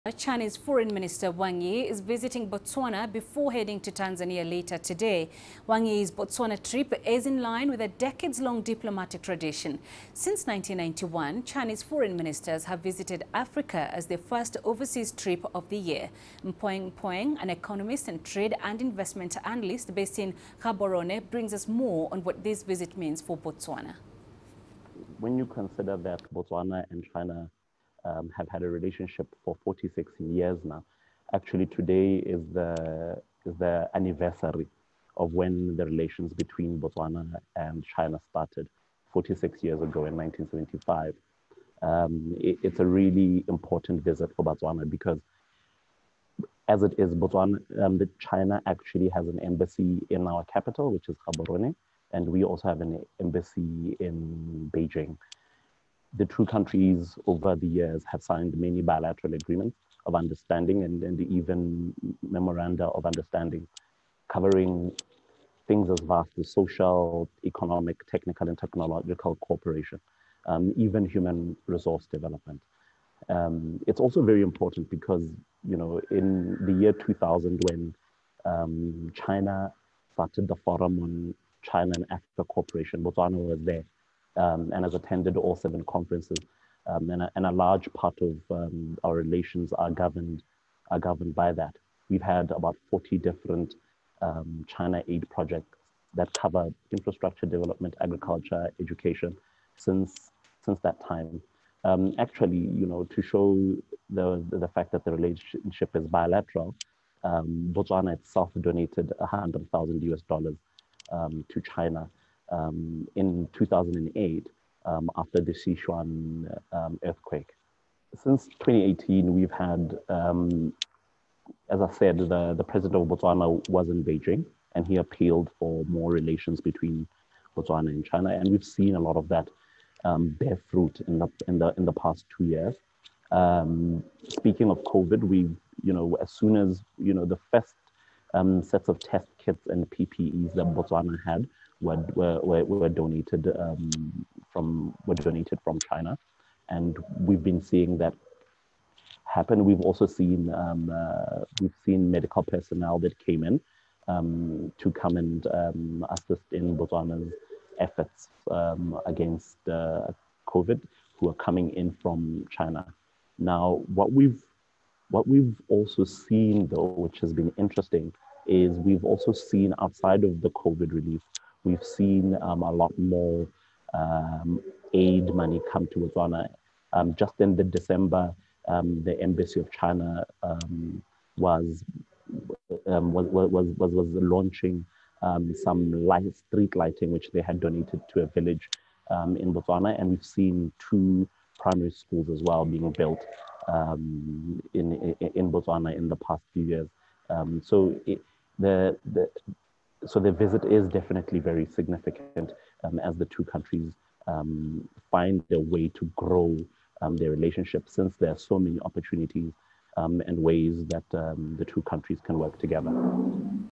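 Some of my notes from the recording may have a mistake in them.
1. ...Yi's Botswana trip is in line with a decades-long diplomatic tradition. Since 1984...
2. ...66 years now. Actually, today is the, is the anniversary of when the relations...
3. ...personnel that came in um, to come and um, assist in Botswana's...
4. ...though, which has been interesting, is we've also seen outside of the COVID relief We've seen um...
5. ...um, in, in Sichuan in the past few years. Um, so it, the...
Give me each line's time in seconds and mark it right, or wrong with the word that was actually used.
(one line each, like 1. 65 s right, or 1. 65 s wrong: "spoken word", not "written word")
1. 5 s wrong: "1991", not "1984"
2. 29 s wrong: "46", not "66"
3. 152 s right
4. 166 s right
5. 193 s wrong: "Botswana", not "Sichuan".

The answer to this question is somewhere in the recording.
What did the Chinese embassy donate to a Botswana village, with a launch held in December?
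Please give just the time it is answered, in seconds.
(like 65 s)
186 s.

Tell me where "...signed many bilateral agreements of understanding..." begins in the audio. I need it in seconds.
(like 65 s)
58 s.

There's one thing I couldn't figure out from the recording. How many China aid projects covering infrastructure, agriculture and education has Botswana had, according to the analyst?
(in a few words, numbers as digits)
40.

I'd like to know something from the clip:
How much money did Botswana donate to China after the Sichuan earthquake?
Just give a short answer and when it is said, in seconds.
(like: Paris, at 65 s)
100,000 US dollars, at 109 s.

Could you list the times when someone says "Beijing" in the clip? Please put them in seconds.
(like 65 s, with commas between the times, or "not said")
54 s, 124 s.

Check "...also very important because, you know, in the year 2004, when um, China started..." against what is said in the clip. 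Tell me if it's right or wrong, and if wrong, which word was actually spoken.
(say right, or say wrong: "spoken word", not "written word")
wrong: "2000", not "2004".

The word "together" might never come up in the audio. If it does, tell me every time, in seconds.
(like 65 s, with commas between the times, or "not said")
212 s.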